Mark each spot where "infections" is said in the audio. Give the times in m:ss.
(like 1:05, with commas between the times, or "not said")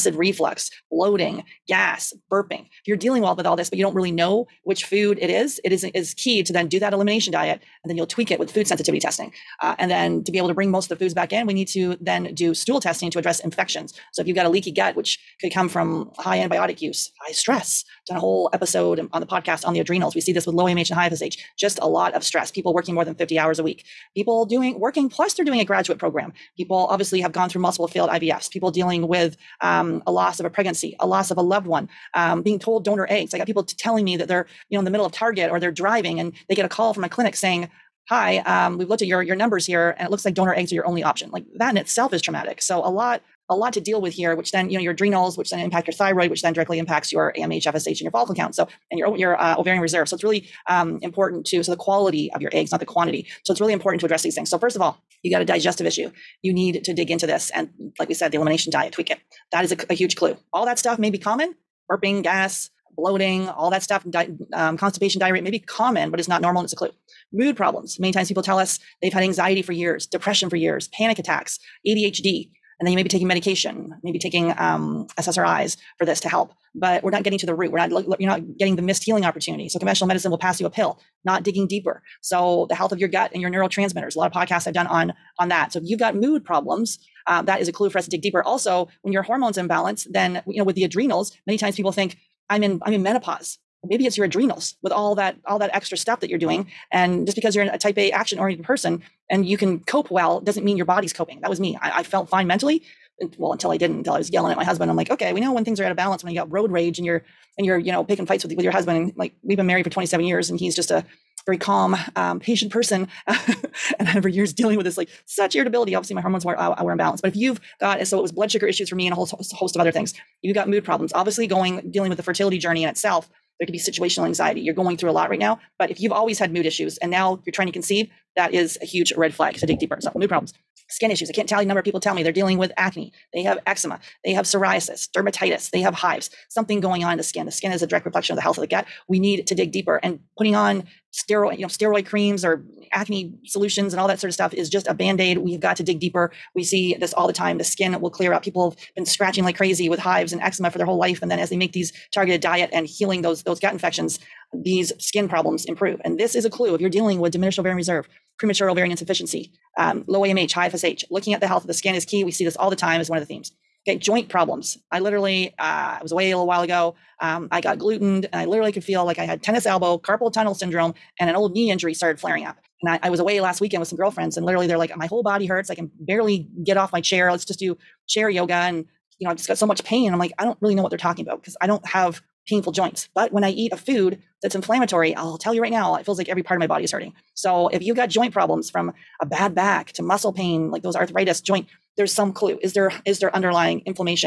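0:13, 2:33.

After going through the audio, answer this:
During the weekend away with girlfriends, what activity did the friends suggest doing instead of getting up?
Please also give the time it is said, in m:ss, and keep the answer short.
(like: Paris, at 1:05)
chair yoga, at 2:58.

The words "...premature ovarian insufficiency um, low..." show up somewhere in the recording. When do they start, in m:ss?
2:38.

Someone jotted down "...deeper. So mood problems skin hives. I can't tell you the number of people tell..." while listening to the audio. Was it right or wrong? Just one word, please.
wrong.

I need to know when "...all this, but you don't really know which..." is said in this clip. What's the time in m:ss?
0:03.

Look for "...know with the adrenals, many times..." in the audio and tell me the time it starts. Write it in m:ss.
1:30.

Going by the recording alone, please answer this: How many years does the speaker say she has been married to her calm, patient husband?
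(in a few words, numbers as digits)
27.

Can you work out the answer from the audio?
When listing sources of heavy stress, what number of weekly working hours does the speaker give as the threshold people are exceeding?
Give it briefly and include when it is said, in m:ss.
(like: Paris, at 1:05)
50, at 0:23.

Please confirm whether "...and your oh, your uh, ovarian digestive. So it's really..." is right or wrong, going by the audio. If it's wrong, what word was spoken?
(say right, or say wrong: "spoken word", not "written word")
wrong: "reserve", not "digestive".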